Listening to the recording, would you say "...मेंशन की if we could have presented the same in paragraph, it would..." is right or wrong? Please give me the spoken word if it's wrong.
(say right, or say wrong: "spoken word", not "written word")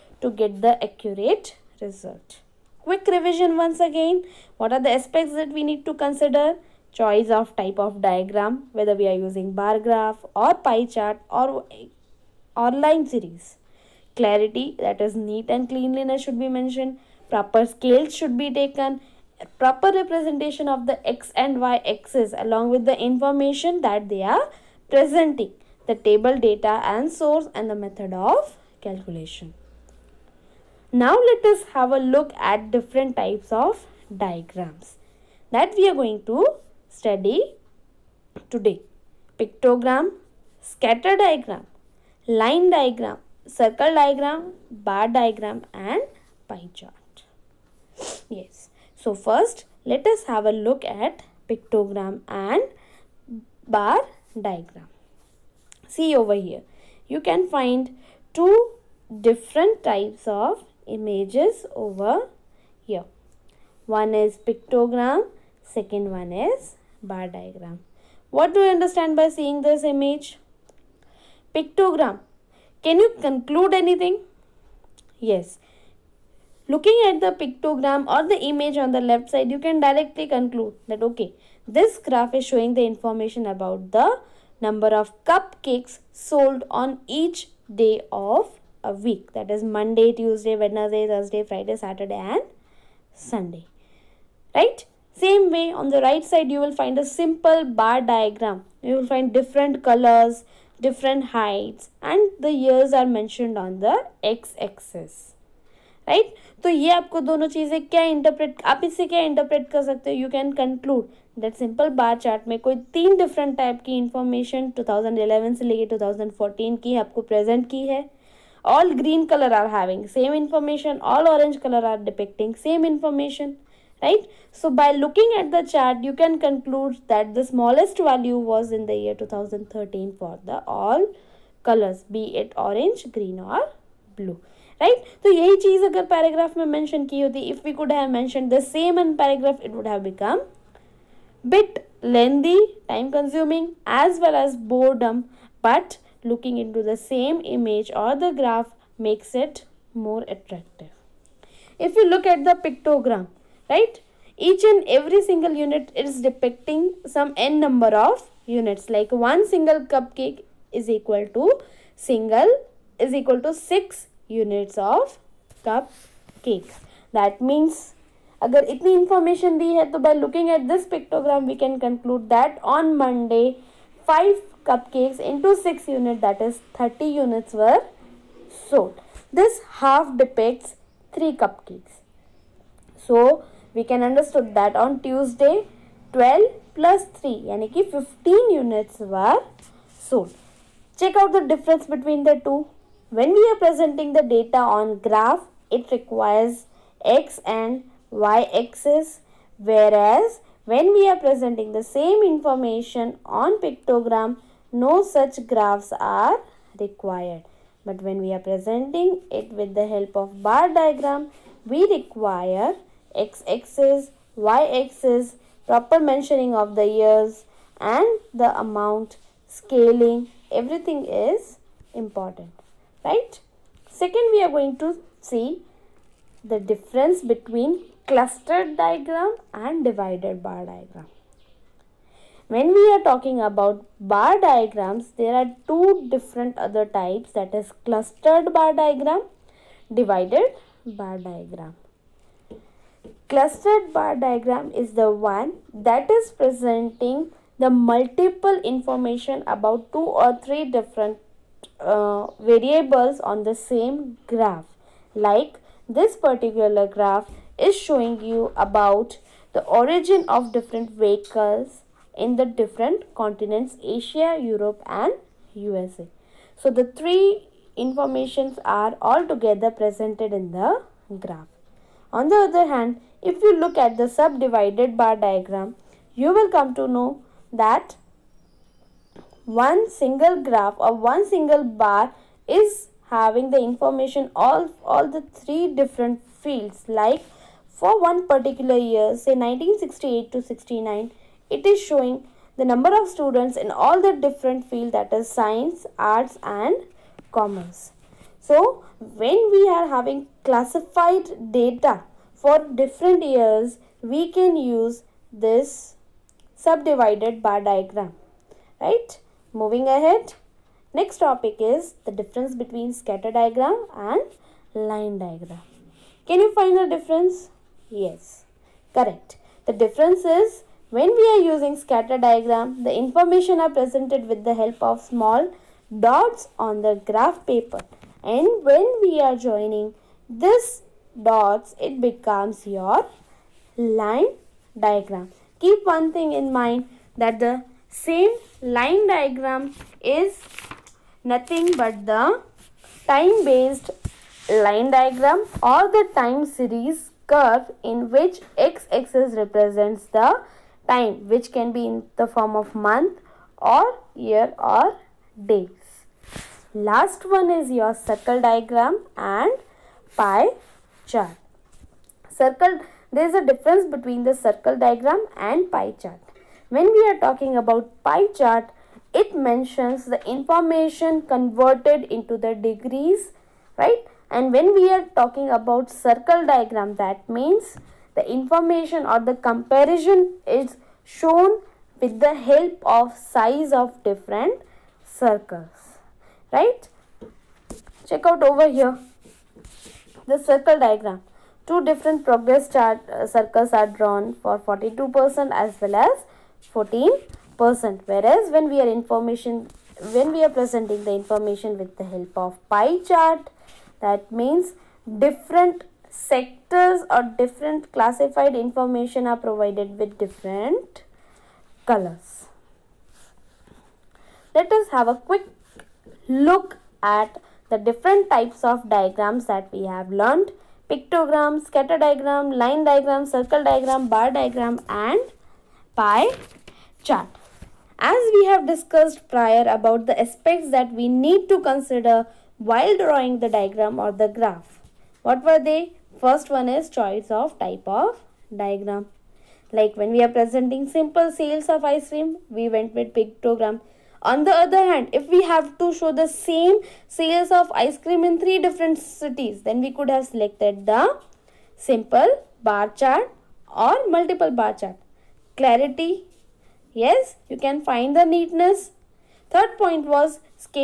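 wrong: "mentioned", not "presented".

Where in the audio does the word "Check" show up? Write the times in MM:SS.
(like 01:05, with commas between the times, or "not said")
03:11, 06:28.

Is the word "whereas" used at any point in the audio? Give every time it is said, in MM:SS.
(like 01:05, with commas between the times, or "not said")
03:19, 06:38.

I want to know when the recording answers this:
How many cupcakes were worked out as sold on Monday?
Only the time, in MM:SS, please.
02:56.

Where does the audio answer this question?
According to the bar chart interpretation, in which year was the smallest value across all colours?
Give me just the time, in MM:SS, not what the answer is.
02:09.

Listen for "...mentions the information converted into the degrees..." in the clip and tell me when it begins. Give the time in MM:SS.
06:09.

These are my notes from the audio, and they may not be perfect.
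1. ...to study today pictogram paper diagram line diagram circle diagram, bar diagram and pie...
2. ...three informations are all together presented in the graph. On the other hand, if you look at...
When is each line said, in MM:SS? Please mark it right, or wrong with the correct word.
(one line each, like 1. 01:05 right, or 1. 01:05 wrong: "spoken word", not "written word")
1. 00:36 wrong: "scatter", not "paper"
2. 04:26 right.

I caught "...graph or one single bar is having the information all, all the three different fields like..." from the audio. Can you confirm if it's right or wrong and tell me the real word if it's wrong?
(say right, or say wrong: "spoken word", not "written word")
right.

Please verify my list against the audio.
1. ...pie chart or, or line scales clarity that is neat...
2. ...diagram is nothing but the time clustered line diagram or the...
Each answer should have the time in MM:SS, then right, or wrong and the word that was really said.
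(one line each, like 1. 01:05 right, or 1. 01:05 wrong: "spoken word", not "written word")
1. 00:10 wrong: "series", not "scales"
2. 05:39 wrong: "based", not "clustered".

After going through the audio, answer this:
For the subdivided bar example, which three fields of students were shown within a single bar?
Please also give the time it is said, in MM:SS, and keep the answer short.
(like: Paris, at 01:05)
science, arts and commerce, at 04:55.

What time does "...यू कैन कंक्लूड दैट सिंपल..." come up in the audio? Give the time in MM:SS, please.
01:50.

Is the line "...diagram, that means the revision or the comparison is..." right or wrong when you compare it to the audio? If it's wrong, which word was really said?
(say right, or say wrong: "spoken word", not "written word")
wrong: "information", not "revision".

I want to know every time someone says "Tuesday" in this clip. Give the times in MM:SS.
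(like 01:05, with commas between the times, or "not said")
01:30, 03:05.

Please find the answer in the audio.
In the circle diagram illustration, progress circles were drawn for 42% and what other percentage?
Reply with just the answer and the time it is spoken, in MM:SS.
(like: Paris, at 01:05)
14%, at 06:36.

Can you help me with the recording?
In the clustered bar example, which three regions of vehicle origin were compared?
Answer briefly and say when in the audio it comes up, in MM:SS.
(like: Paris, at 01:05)
Asia, Europe and USA, at 04:23.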